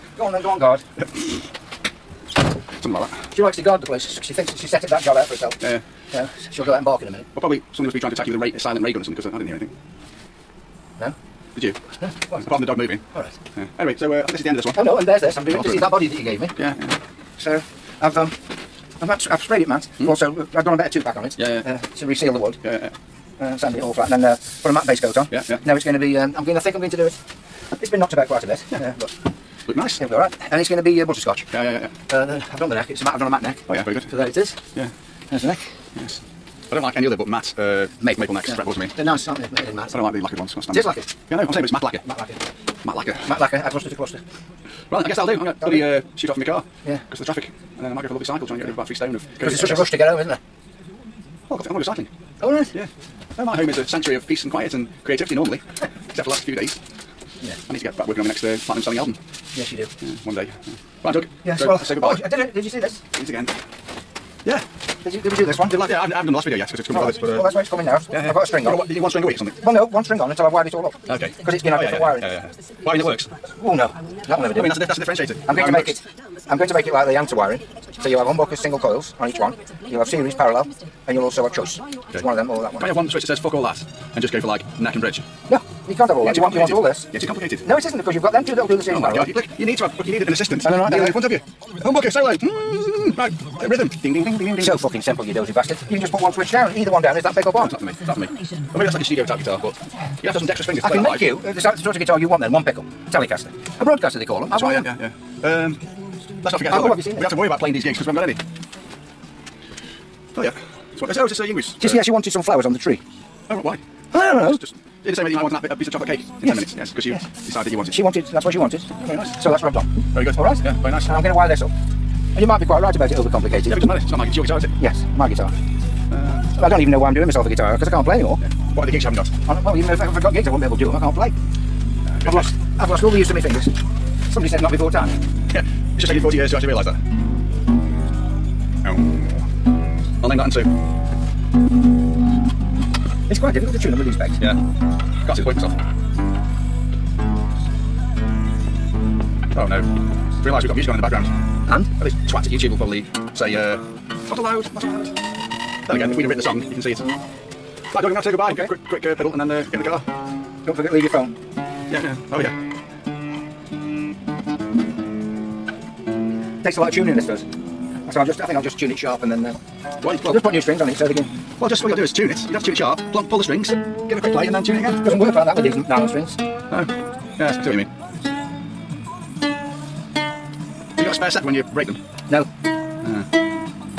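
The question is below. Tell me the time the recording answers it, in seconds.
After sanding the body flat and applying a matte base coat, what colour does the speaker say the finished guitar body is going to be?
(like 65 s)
31 s.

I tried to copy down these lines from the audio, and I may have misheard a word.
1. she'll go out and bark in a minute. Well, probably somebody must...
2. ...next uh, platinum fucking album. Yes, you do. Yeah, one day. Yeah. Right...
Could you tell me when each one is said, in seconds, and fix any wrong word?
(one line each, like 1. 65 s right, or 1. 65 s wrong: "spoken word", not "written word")
1. 6 s right
2. 58 s wrong: "selling", not "fucking".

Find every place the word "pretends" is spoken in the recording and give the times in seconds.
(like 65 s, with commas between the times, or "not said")
not said.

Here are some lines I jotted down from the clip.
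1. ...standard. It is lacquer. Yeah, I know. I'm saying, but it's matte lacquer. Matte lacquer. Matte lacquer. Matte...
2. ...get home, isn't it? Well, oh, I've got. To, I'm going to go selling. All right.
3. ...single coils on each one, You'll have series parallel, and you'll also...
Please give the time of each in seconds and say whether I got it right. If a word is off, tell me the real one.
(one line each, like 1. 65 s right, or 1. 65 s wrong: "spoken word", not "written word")
1. 40 s right
2. 49 s wrong: "cycling", not "selling"
3. 78 s right.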